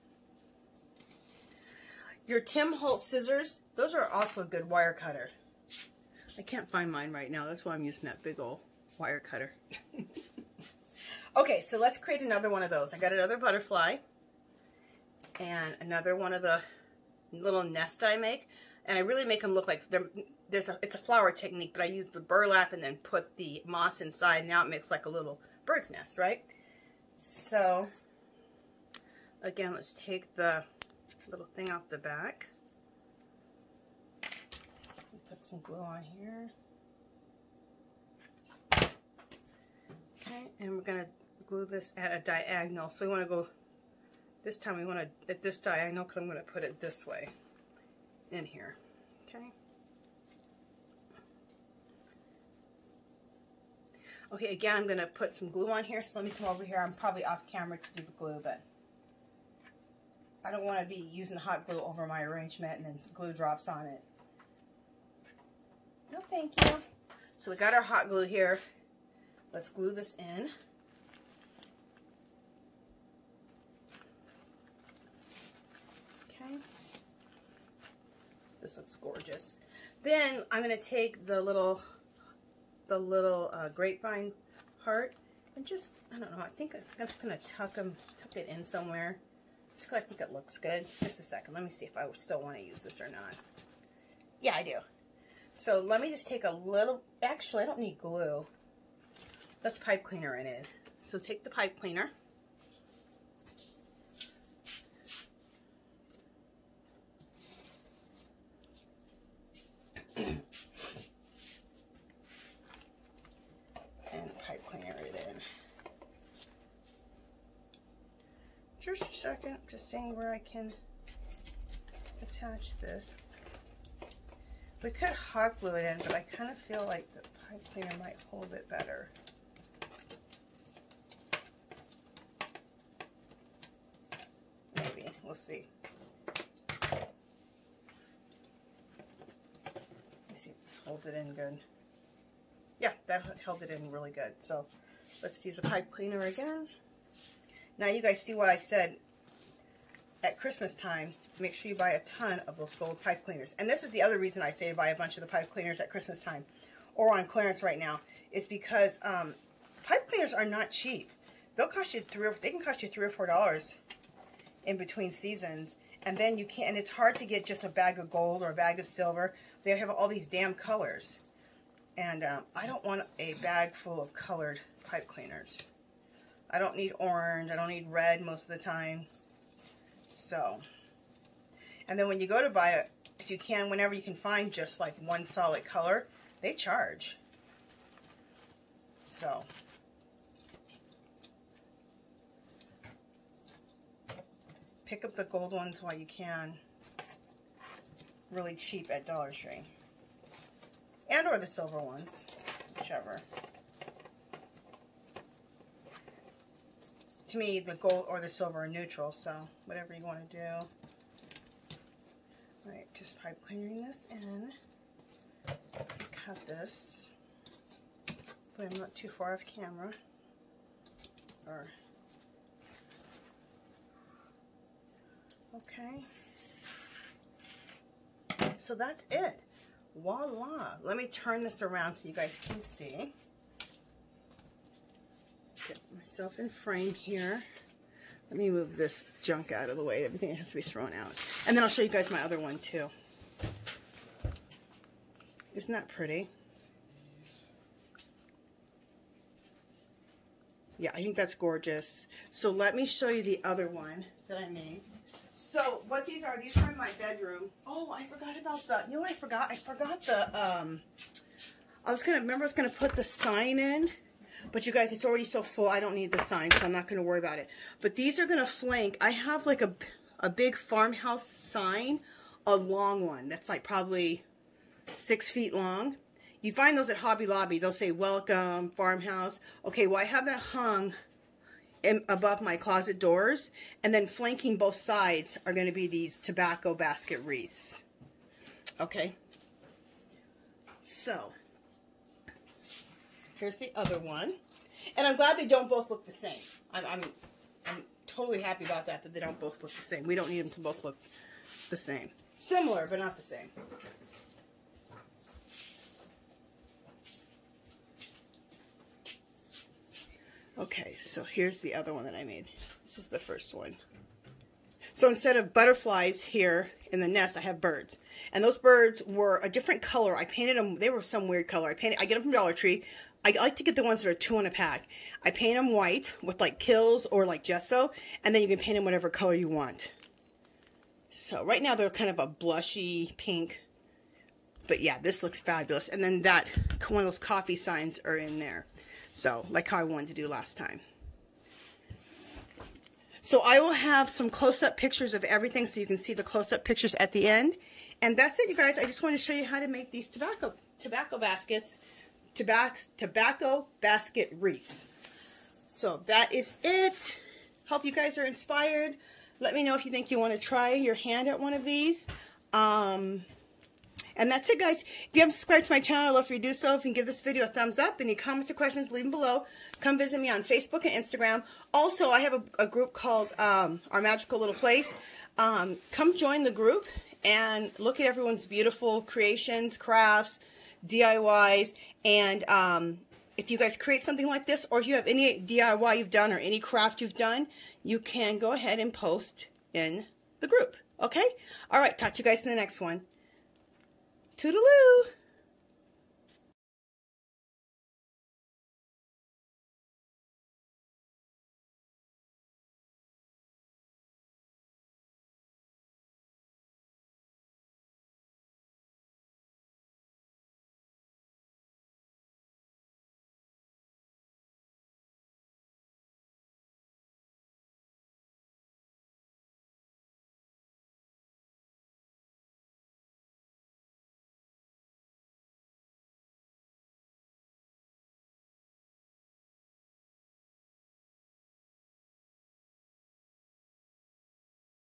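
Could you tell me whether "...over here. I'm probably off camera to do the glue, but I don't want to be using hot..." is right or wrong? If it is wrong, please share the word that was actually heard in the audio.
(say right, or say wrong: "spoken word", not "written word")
right.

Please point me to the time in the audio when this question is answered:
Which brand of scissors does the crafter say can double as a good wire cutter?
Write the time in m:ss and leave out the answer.
0:02.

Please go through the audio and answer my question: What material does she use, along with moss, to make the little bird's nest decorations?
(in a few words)
burlap.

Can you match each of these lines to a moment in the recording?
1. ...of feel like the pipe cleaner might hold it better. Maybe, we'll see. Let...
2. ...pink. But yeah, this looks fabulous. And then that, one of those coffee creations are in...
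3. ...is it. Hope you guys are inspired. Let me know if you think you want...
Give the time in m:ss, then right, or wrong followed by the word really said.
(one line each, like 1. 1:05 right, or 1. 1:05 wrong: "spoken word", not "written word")
1. 2:06 right
2. 5:33 wrong: "signs", not "creations"
3. 5:56 right.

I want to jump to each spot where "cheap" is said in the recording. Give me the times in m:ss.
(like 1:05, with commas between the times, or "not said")
2:40, 3:18.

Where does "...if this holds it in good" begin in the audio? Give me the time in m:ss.
2:20.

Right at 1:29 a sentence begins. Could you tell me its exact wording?
Just because I think it looks good.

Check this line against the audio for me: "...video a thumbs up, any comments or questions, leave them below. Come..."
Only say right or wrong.
right.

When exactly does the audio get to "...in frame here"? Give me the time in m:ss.
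3:56.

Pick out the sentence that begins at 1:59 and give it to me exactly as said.
seeing where I can attach this.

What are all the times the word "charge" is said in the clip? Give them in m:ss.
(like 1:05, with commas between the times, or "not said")
3:06.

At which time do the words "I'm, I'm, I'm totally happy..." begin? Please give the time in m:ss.
4:56.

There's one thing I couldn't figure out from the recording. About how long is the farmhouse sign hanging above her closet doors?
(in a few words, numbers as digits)
6 feet.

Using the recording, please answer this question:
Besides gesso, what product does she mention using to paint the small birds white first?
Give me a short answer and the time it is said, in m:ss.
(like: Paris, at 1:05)
Kilz, at 5:26.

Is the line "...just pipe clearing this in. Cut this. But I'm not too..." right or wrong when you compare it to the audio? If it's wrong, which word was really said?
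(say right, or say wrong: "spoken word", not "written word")
right.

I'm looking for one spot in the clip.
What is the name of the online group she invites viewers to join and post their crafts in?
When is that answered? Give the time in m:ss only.
6:13.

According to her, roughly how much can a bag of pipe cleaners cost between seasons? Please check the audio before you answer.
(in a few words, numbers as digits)
3 or 4 dollars.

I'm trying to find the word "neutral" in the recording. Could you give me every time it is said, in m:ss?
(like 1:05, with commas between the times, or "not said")
3:28.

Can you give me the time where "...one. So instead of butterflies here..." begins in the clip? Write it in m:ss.
5:13.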